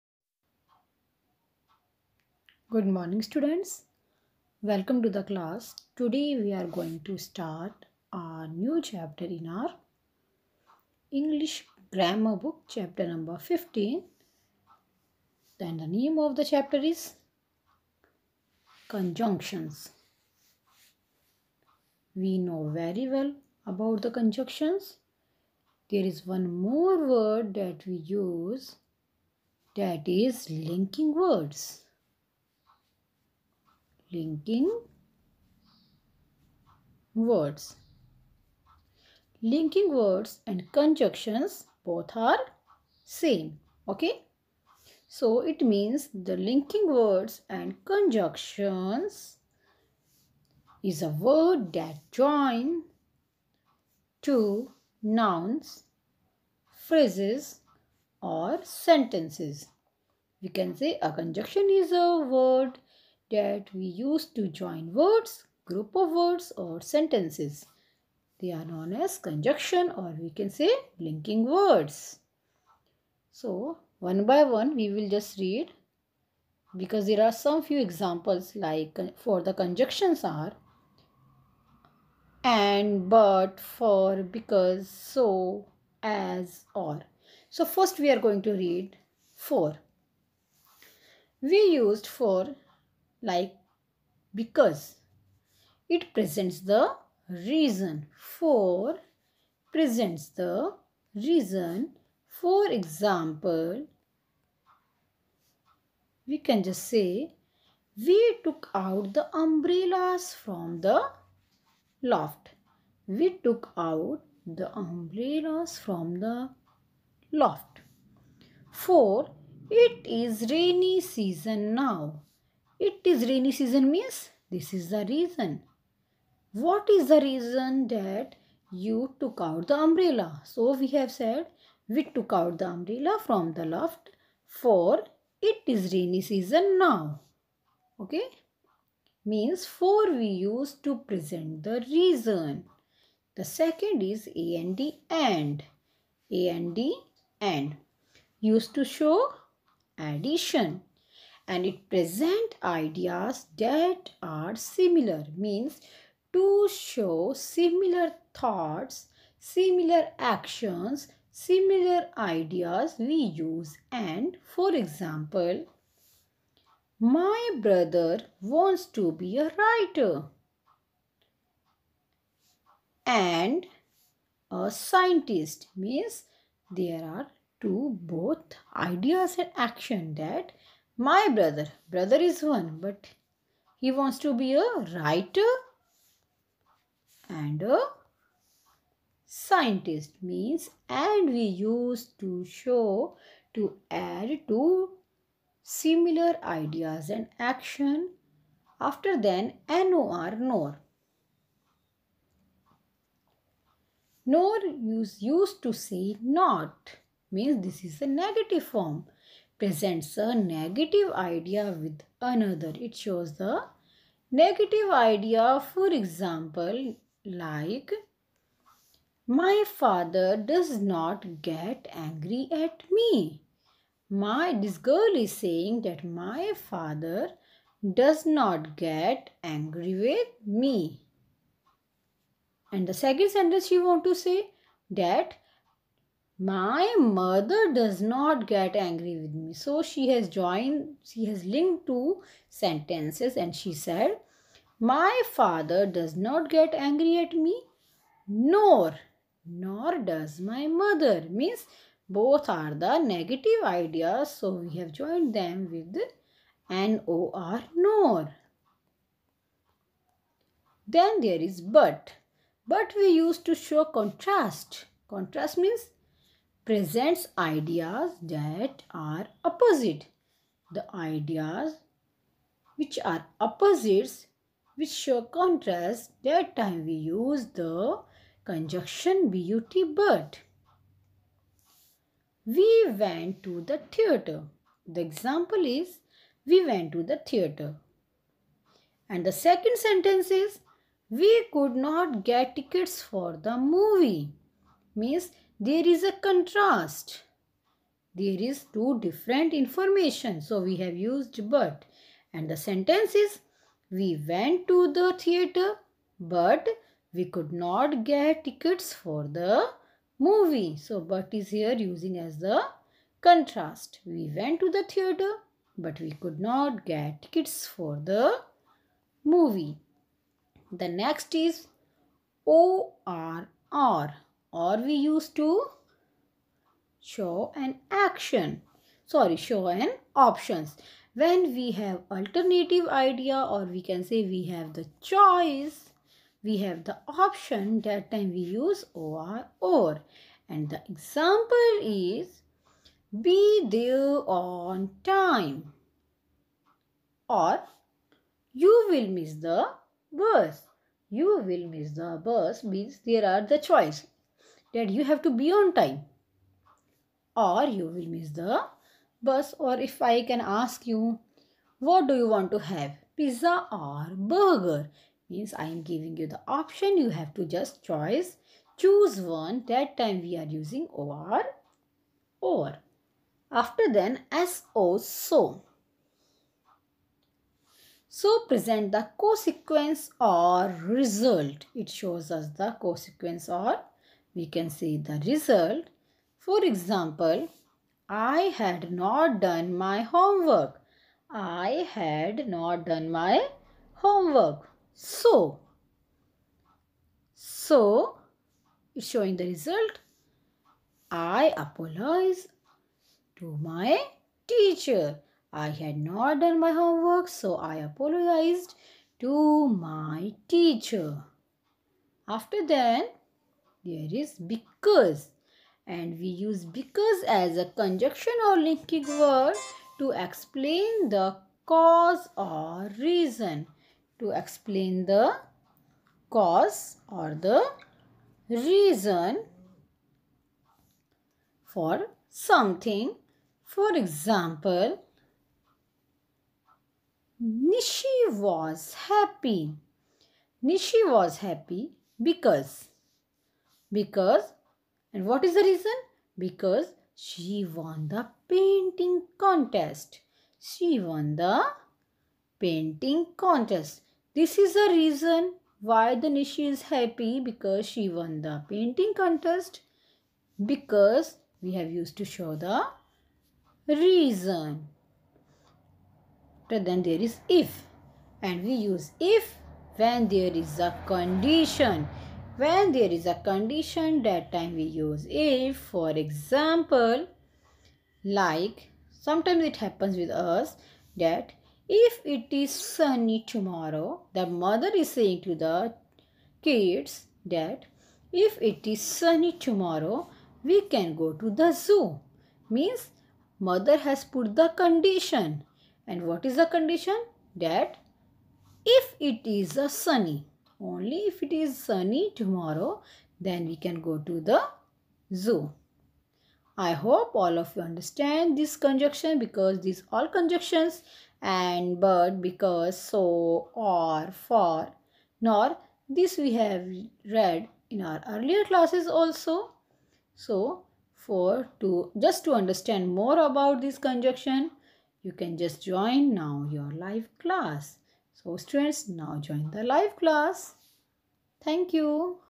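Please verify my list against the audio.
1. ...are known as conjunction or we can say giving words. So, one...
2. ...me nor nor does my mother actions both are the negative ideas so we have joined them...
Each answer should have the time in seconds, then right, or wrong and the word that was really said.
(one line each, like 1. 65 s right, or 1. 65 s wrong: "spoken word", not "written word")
1. 68 s wrong: "linking", not "giving"
2. 247 s wrong: "means", not "actions".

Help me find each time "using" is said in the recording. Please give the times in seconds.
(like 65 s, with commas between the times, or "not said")
311 s, 370 s.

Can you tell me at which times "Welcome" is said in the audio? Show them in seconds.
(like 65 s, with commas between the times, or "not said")
4 s.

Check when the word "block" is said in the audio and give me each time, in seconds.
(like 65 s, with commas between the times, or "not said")
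not said.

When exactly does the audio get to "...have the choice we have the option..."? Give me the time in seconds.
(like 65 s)
334 s.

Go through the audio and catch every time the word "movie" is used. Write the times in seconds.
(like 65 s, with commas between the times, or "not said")
293 s, 310 s, 319 s.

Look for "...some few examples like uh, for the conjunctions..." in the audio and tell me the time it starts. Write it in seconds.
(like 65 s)
77 s.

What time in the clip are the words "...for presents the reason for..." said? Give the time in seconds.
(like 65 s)
98 s.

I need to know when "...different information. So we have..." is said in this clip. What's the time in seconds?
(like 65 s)
298 s.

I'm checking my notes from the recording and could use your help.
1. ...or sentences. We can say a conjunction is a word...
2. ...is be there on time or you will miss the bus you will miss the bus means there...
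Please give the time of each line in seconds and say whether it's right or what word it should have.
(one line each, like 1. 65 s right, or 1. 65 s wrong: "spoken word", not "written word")
1. 58 s right
2. 341 s right.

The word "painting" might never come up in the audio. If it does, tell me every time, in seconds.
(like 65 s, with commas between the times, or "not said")
448 s, 452 s, 458 s.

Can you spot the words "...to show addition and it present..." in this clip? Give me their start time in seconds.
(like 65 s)
148 s.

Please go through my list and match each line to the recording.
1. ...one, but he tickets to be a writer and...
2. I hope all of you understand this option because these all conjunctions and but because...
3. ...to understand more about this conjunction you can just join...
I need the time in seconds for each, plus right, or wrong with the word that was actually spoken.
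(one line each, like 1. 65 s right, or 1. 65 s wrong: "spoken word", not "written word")
1. 182 s wrong: "wants", not "tickets"
2. 506 s wrong: "conjunction", not "option"
3. 522 s right.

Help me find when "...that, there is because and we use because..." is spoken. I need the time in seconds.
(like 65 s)
412 s.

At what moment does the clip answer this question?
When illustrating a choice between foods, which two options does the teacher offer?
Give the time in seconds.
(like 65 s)
363 s.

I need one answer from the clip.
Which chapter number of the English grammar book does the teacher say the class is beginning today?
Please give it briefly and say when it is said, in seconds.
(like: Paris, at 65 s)
15, at 12 s.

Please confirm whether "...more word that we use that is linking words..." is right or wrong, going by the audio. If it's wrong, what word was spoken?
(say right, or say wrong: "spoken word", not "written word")
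right.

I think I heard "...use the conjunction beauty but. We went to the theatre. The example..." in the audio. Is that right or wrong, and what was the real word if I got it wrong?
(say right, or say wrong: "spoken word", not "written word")
right.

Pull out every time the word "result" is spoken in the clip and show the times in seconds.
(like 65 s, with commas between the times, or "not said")
380 s, 385 s, 399 s.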